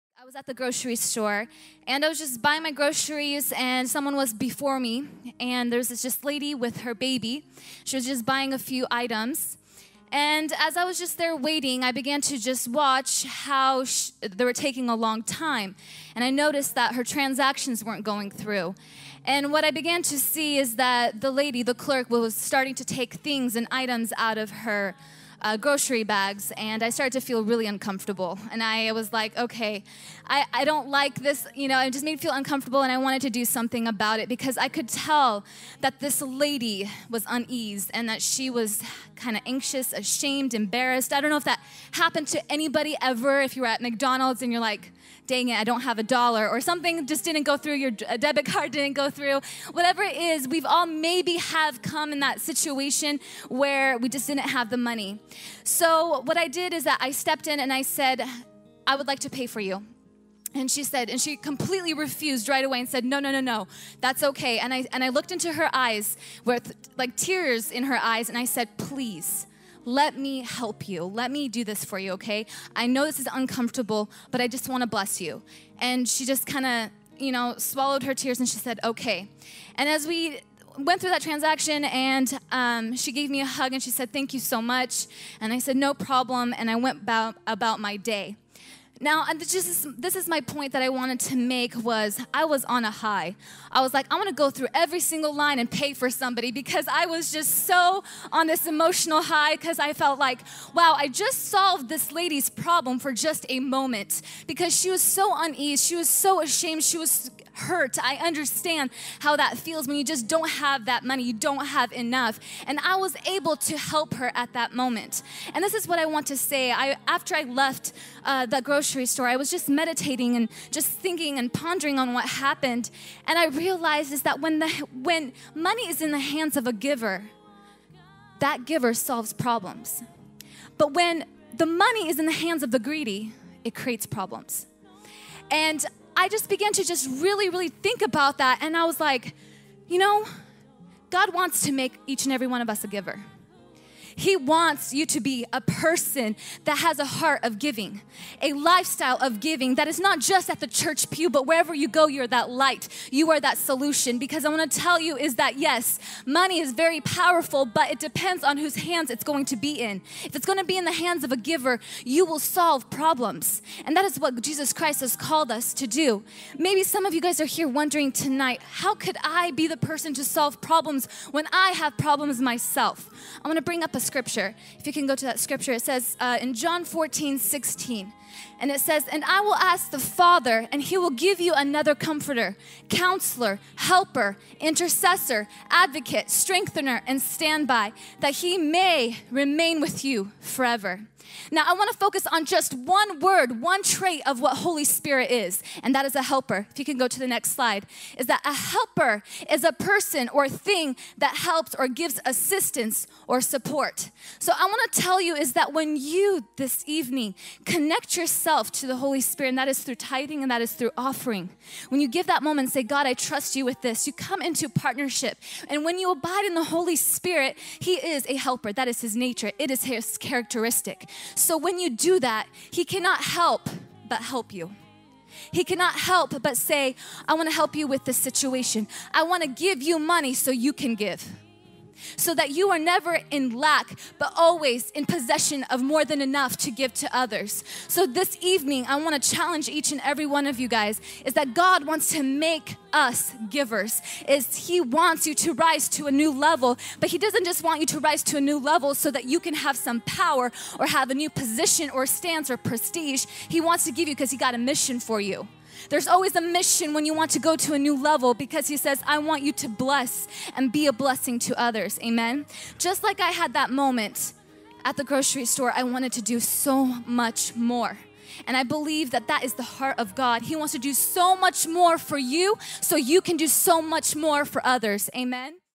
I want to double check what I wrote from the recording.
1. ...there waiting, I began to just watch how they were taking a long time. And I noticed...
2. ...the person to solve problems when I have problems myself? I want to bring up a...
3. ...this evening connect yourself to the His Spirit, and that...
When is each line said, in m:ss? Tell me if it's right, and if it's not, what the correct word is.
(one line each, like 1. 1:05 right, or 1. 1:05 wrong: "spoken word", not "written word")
1. 0:11 right
2. 2:49 right
3. 3:26 wrong: "Holy", not "His".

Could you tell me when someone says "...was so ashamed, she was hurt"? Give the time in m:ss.
1:45.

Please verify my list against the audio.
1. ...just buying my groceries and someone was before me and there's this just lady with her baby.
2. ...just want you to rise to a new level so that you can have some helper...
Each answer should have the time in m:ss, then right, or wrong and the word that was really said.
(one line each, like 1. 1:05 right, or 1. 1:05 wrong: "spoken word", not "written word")
1. 0:02 right
2. 4:07 wrong: "power", not "helper".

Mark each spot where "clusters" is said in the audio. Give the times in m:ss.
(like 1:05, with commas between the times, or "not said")
not said.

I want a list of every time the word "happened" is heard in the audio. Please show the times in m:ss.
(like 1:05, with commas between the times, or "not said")
0:41, 2:02.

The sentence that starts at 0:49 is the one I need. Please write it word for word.
Whatever it is, we've all maybe have come in that situation where we just didn't have the money.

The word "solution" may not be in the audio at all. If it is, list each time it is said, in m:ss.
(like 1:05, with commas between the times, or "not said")
2:33.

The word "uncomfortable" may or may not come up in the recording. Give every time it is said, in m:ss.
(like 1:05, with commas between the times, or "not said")
0:27, 0:32, 1:13.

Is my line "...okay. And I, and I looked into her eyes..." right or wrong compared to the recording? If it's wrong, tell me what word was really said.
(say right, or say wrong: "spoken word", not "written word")
right.